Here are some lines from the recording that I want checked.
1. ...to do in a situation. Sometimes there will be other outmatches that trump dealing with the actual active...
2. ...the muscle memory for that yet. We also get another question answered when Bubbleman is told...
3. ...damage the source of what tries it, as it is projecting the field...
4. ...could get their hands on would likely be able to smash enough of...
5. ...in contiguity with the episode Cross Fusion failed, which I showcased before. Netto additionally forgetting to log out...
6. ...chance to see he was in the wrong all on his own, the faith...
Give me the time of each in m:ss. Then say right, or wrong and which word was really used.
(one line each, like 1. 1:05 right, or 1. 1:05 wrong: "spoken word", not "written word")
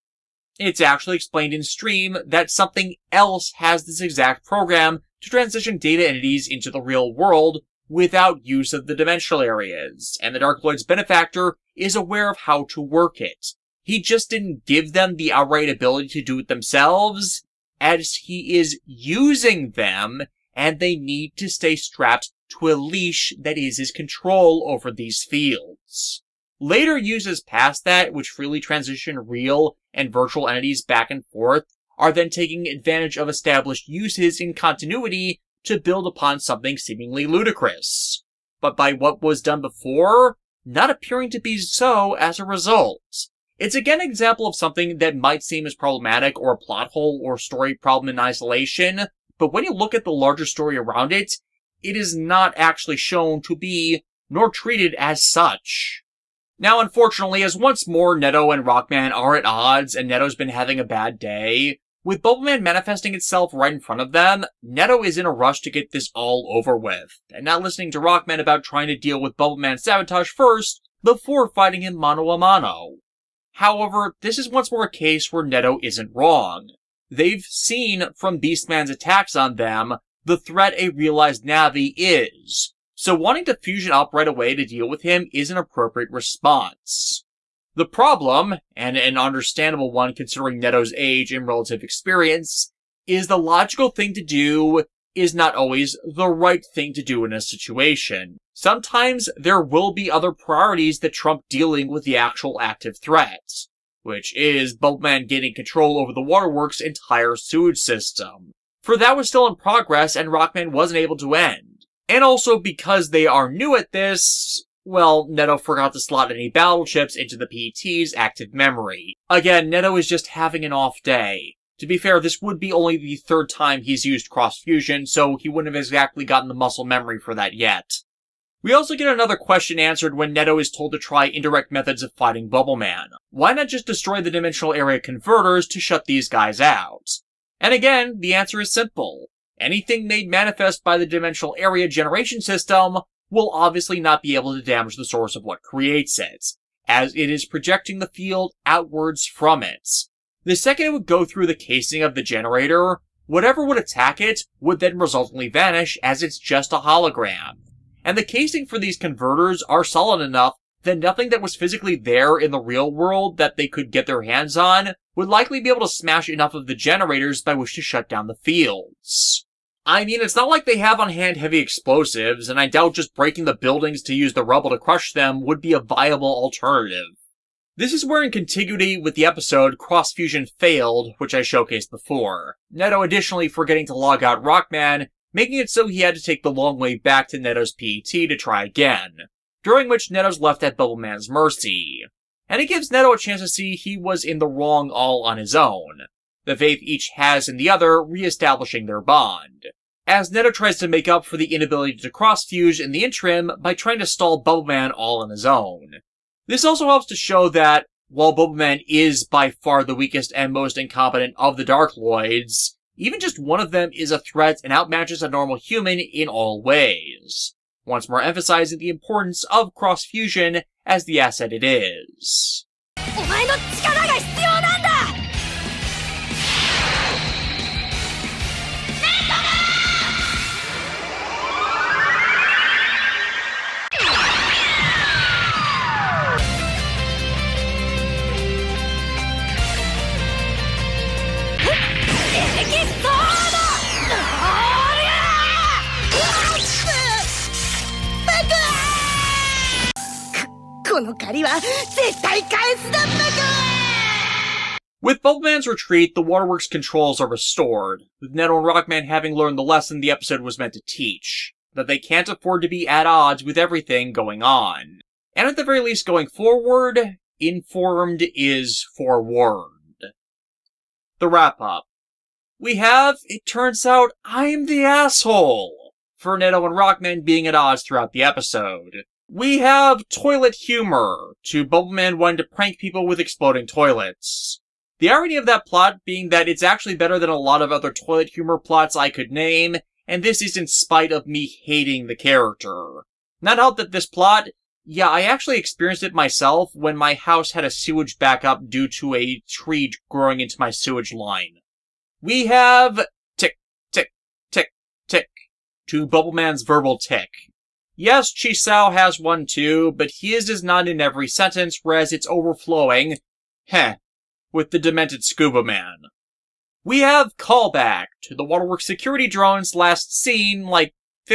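1. 1:36 wrong: "priorities", not "outmatches"
2. 2:06 wrong: "Netto", not "Bubbleman"
3. 2:24 wrong: "creates", not "tries"
4. 2:43 right
5. 2:58 right
6. 3:13 right.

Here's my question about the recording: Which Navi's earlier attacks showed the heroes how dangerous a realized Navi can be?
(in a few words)
Beastman.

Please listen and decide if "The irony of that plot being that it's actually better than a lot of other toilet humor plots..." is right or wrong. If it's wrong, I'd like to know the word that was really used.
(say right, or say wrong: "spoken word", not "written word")
right.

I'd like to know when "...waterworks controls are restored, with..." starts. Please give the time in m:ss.
4:16.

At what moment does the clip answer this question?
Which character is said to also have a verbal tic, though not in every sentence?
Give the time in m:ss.
5:08.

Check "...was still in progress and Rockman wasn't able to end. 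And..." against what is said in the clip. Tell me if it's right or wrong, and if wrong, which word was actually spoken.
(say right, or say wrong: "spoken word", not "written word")
right.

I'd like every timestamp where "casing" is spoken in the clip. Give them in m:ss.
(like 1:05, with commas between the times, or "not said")
2:31, 2:38.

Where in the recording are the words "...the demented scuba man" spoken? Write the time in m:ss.
5:14.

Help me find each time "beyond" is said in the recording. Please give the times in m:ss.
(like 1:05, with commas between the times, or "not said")
not said.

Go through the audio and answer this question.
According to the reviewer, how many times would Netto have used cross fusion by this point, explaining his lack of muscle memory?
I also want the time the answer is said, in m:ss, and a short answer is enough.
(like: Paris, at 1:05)
3, at 2:03.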